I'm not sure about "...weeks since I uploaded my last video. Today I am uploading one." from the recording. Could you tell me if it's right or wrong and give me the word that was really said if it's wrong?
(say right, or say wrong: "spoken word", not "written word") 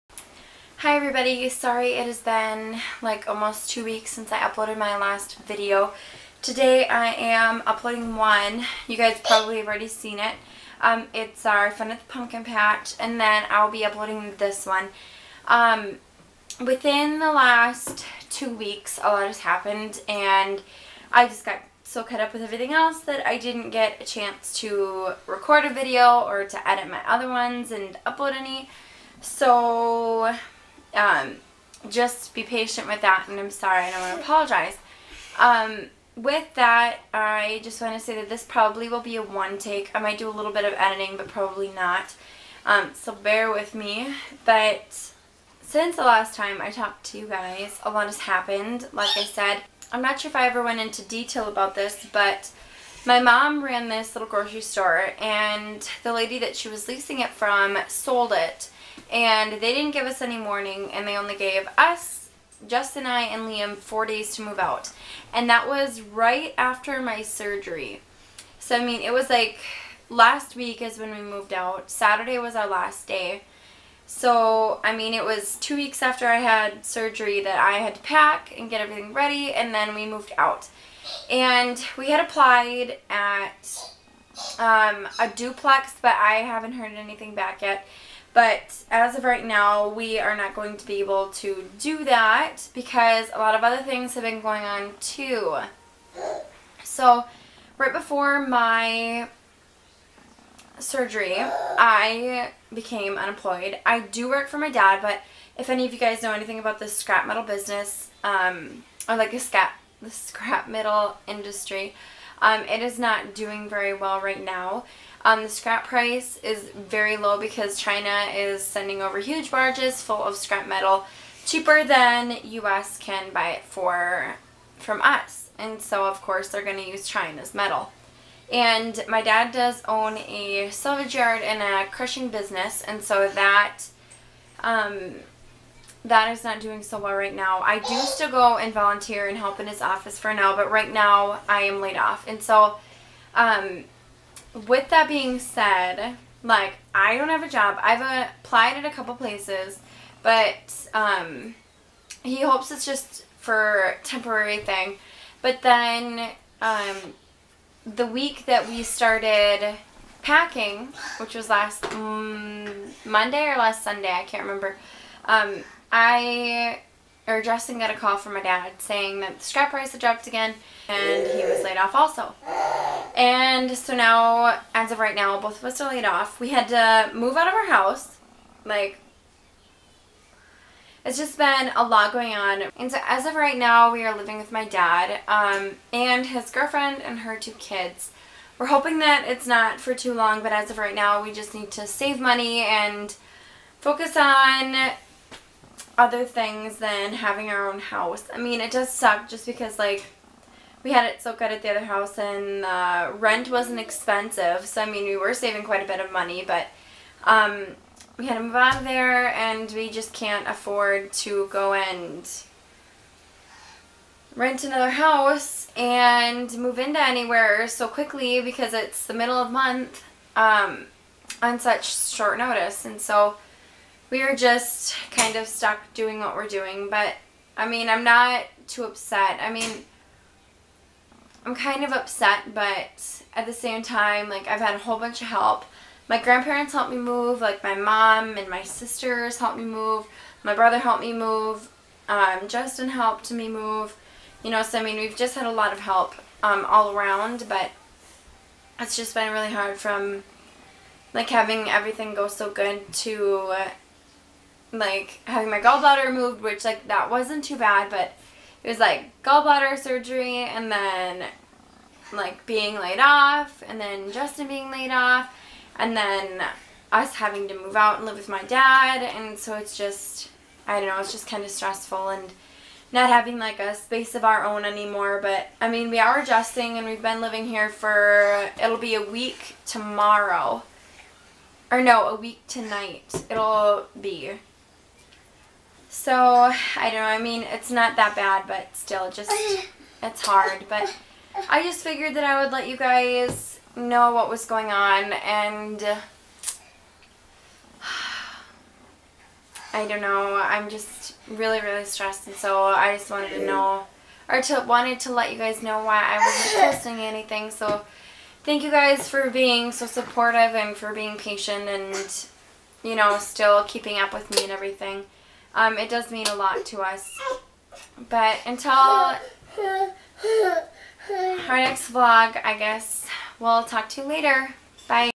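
right.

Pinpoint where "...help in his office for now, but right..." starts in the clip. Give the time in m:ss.
2:19.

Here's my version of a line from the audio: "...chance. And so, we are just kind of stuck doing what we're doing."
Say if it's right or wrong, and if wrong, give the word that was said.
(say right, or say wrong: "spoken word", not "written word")
wrong: "notice", not "chance".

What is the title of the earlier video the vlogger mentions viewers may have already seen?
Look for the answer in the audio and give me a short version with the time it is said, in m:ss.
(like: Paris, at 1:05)
Fun at the Pumpkin Patch, at 0:11.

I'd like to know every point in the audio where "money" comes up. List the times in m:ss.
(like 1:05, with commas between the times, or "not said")
3:12, 3:26.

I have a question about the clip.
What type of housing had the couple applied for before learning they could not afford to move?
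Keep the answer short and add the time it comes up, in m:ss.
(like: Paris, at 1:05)
a duplex, at 1:25.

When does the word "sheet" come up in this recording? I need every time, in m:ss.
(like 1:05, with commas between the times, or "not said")
not said.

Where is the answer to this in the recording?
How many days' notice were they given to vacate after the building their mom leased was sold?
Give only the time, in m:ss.
1:03.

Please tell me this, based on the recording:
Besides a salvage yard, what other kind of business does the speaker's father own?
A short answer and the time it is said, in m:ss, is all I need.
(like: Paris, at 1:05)
crushing business, at 2:11.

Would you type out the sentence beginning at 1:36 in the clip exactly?
So, right before my surgery, I became unemployed.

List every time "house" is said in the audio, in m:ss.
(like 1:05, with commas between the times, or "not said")
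2:57, 3:17, 3:21, 3:34.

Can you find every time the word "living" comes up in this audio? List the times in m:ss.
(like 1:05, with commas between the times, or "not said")
3:04, 4:37.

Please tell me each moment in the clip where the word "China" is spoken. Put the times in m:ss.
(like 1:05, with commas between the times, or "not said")
1:57, 2:07.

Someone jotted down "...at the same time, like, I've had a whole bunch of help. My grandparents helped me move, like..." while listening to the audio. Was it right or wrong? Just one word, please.
right.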